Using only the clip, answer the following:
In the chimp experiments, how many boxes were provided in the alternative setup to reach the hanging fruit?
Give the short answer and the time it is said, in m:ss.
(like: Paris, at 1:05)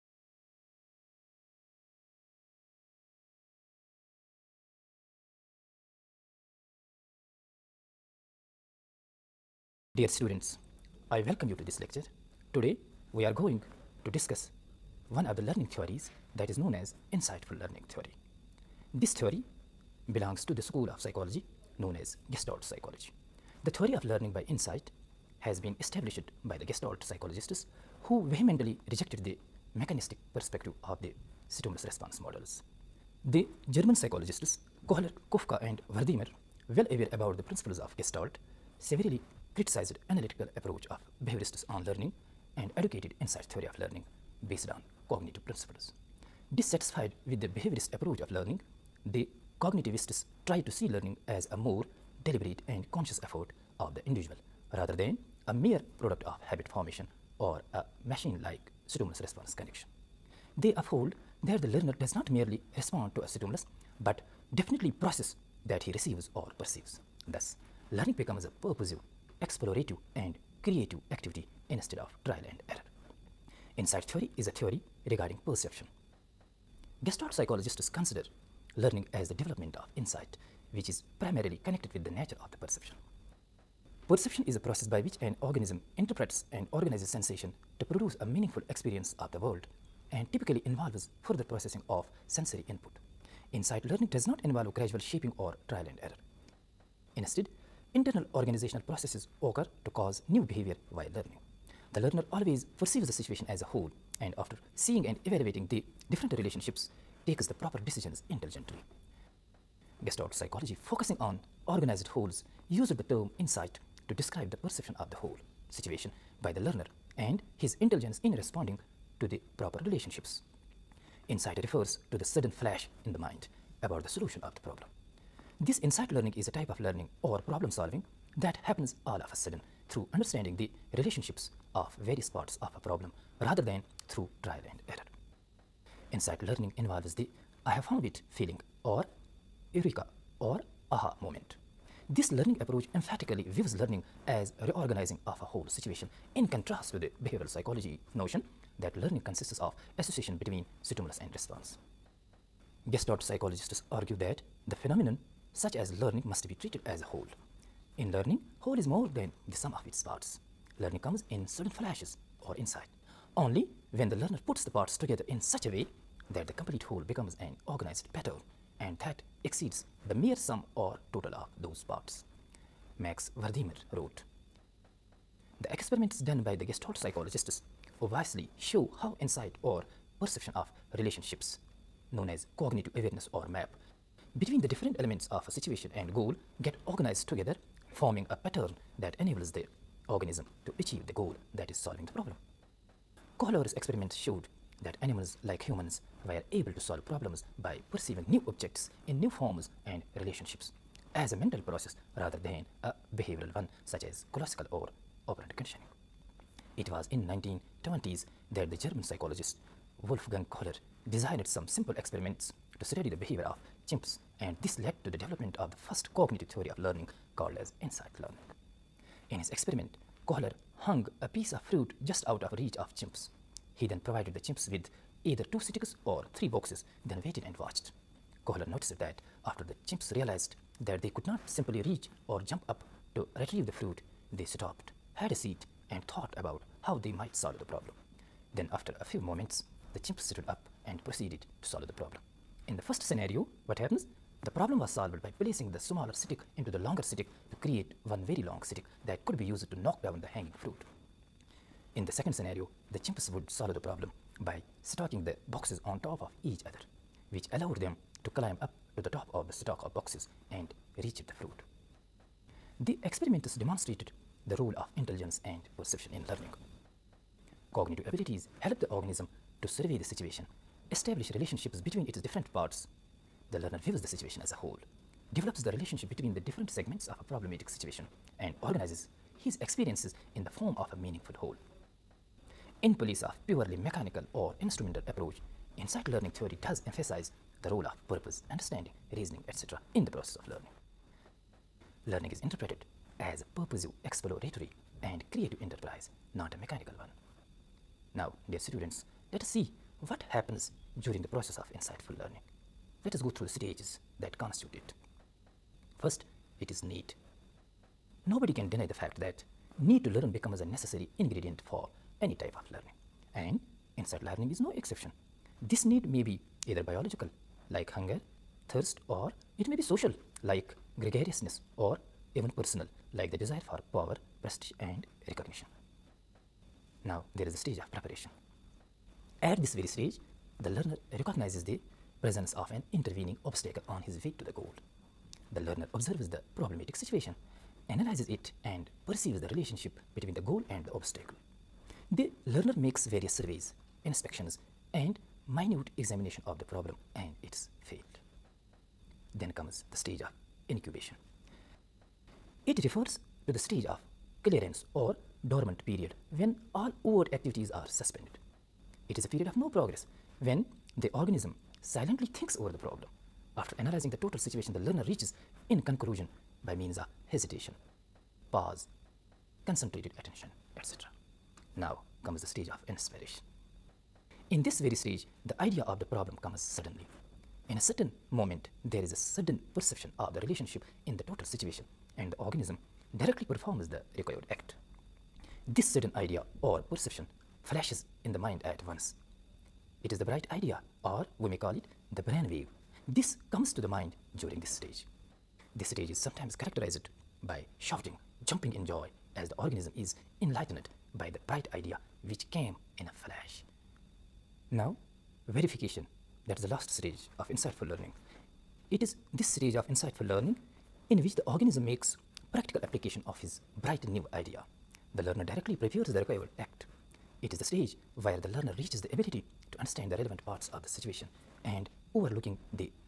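3, at 3:46.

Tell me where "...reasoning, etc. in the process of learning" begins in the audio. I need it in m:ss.
4:49.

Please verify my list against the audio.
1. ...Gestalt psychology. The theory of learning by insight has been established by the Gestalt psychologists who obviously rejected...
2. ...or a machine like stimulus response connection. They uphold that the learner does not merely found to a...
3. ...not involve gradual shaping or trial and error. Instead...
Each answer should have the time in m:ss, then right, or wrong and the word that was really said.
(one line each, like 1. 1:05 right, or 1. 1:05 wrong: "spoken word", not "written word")
1. 0:22 wrong: "vehemently", not "obviously"
2. 0:57 wrong: "respond", not "found"
3. 1:34 right.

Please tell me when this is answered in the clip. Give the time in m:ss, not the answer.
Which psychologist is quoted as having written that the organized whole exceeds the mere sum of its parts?
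2:52.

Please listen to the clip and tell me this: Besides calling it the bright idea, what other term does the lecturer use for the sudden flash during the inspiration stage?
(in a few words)
brain wave.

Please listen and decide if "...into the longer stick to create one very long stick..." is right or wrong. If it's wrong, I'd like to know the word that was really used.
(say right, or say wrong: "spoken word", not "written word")
right.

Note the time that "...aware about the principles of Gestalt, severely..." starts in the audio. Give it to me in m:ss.
0:36.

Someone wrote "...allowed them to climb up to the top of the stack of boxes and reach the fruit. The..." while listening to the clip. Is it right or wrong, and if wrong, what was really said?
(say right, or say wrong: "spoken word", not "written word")
right.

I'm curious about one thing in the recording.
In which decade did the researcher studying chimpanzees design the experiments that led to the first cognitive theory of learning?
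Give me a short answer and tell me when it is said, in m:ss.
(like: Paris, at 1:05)
1920s, at 3:27.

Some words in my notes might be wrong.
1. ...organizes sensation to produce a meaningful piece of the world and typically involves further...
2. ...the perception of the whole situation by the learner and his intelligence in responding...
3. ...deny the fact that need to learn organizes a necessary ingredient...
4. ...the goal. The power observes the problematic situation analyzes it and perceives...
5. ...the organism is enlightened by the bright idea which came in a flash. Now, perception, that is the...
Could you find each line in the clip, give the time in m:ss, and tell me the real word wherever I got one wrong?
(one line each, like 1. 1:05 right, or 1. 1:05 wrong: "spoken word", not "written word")
1. 1:26 wrong: "experience", not "piece"
2. 1:54 right
3. 5:08 wrong: "becomes", not "organizes"
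4. 5:34 wrong: "learner", not "power"
5. 6:39 wrong: "verification", not "perception".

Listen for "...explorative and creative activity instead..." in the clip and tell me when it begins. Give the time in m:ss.
1:09.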